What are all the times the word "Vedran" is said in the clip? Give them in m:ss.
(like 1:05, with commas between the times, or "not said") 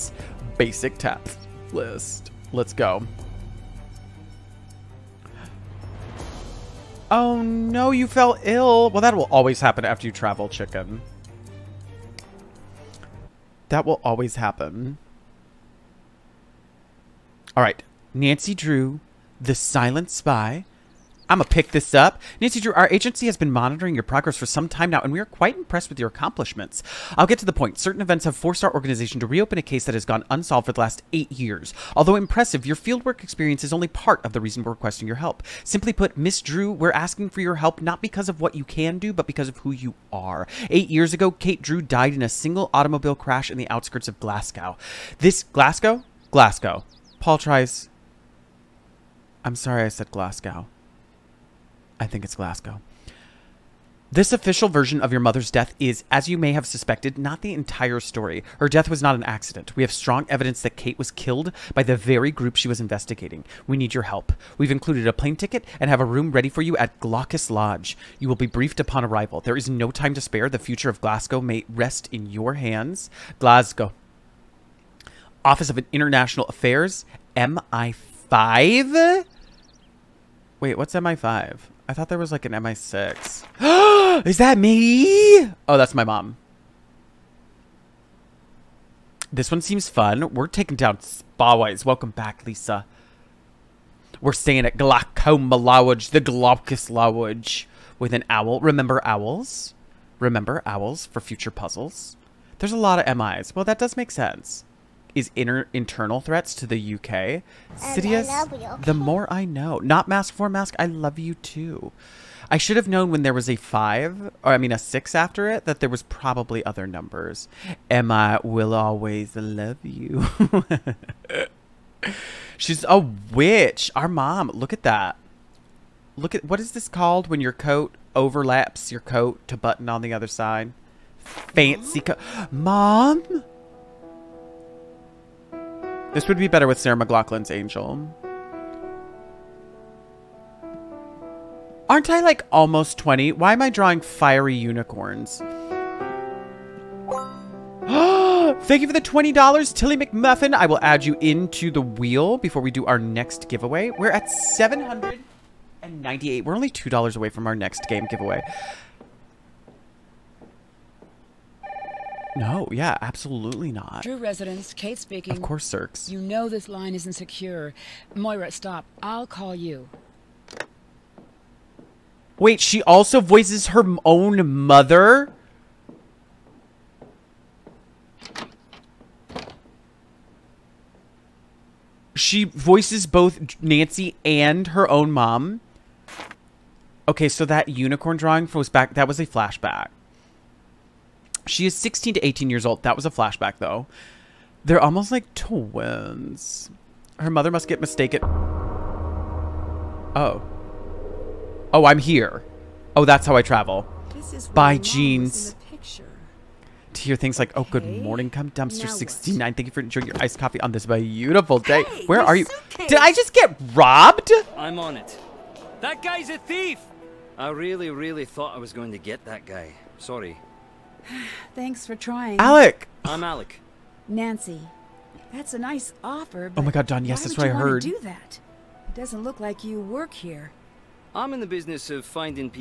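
not said.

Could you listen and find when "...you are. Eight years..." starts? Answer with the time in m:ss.
0:39.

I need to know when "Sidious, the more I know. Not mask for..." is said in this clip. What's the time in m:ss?
1:47.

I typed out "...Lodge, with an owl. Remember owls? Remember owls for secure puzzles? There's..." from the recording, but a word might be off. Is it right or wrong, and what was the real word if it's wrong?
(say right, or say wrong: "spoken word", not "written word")
wrong: "future", not "secure".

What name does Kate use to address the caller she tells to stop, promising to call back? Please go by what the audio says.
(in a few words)
Moira.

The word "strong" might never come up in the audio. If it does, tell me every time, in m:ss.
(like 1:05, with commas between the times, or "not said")
0:59.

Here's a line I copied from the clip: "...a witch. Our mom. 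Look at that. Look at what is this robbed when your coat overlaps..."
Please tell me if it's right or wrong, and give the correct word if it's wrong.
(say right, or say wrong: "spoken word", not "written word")
wrong: "called", not "robbed".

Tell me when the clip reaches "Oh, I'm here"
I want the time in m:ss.
3:21.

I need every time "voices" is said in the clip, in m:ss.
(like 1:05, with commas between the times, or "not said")
2:53, 3:02.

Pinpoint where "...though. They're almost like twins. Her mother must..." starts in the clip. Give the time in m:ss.
3:13.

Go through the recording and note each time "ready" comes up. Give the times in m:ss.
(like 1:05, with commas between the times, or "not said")
1:06.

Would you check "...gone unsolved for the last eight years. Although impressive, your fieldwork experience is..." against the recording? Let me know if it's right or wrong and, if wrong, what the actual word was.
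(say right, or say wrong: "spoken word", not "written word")
right.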